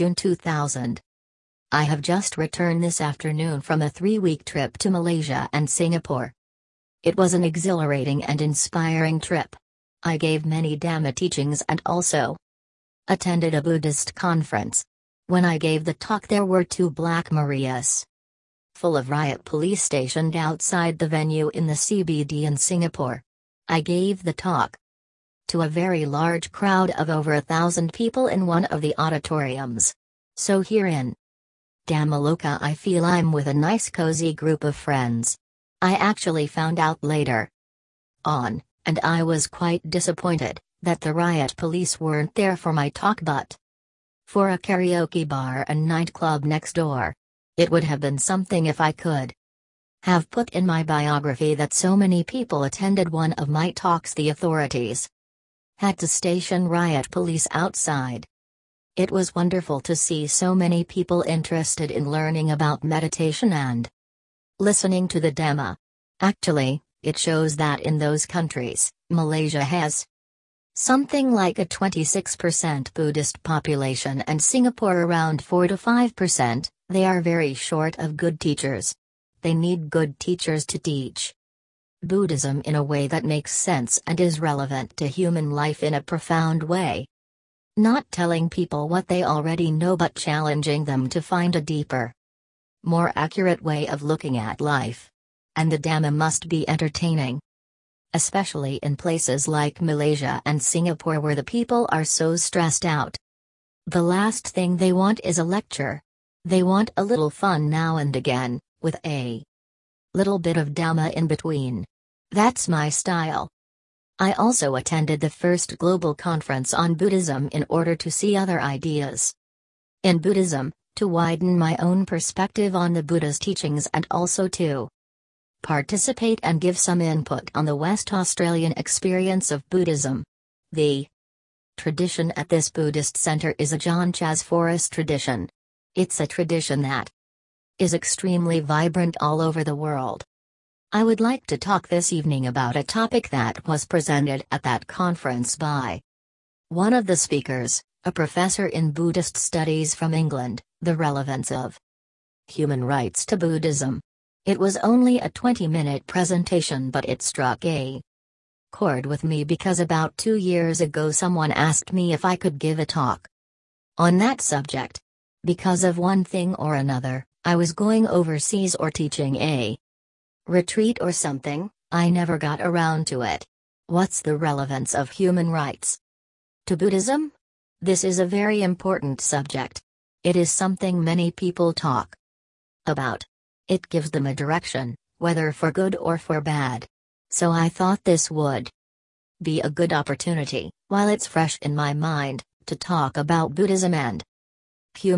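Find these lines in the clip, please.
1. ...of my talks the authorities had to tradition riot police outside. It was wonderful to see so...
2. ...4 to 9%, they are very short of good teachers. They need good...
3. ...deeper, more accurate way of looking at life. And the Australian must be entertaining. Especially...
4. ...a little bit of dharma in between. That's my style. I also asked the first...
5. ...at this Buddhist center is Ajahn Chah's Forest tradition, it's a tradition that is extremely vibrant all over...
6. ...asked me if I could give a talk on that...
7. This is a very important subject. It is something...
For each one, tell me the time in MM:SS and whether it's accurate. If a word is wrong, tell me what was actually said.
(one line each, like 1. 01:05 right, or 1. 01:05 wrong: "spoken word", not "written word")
1. 00:53 wrong: "station", not "tradition"
2. 01:15 wrong: "5", not "9"
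3. 01:31 wrong: "Dhamma", not "Australian"
4. 01:49 wrong: "attended", not "asked"
5. 02:12 right
6. 02:41 right
7. 02:57 right.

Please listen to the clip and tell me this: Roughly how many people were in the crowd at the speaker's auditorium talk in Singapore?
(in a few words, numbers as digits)
over 1,000.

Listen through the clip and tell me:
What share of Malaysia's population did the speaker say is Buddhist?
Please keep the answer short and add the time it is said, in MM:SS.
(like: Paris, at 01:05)
26%, at 01:11.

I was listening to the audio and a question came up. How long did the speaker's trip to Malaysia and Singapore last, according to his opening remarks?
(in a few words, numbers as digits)
3 weeks.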